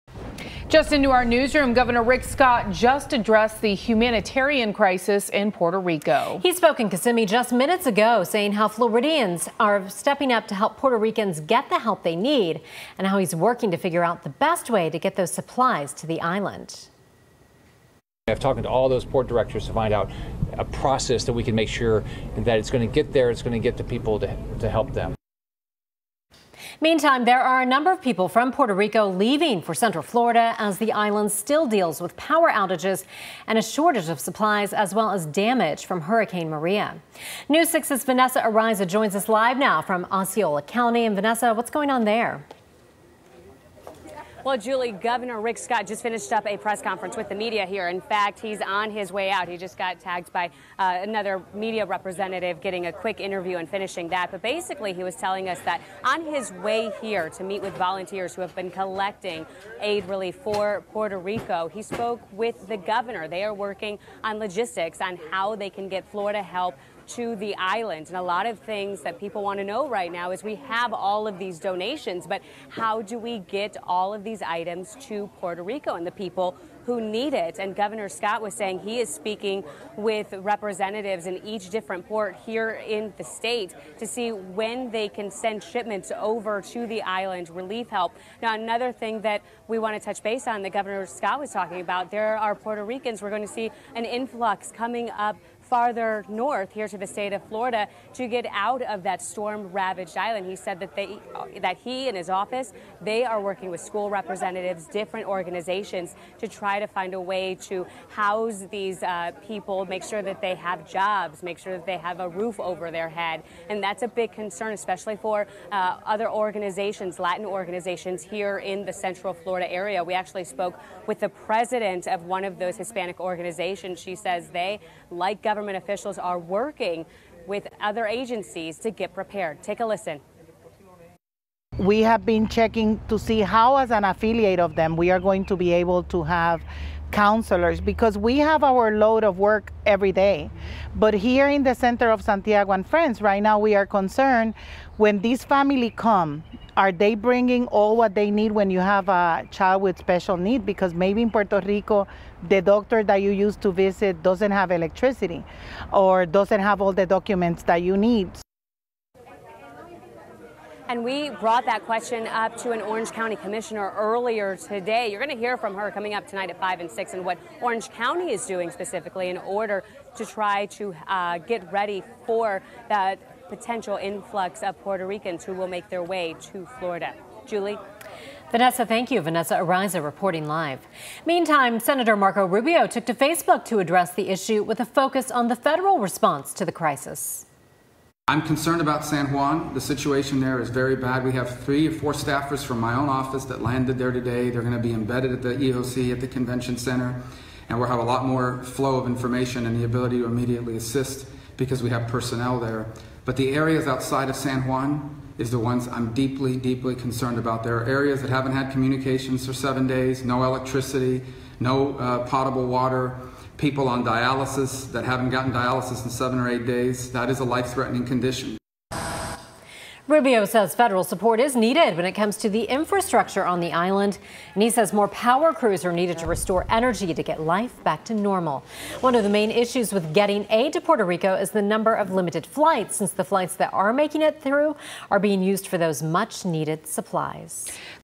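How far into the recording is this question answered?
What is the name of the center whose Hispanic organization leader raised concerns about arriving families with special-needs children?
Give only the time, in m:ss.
2:22.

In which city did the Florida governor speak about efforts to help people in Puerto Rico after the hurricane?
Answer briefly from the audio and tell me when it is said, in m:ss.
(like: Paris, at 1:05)
Kissimmee, at 0:06.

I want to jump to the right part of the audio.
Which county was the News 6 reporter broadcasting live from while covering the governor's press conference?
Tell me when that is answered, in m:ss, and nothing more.
0:40.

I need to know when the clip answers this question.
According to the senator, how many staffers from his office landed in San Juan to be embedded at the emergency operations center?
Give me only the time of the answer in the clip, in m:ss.
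3:11.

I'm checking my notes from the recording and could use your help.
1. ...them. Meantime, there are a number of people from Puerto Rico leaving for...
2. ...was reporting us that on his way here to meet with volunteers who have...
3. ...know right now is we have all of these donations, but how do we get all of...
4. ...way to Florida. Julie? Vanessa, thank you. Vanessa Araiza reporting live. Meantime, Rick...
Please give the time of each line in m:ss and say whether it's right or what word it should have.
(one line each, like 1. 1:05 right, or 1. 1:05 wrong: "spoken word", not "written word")
1. 0:24 right
2. 0:55 wrong: "telling", not "reporting"
3. 1:09 right
4. 2:56 wrong: "Senator", not "Rick".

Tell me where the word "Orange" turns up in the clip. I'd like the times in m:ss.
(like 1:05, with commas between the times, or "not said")
2:42, 2:47.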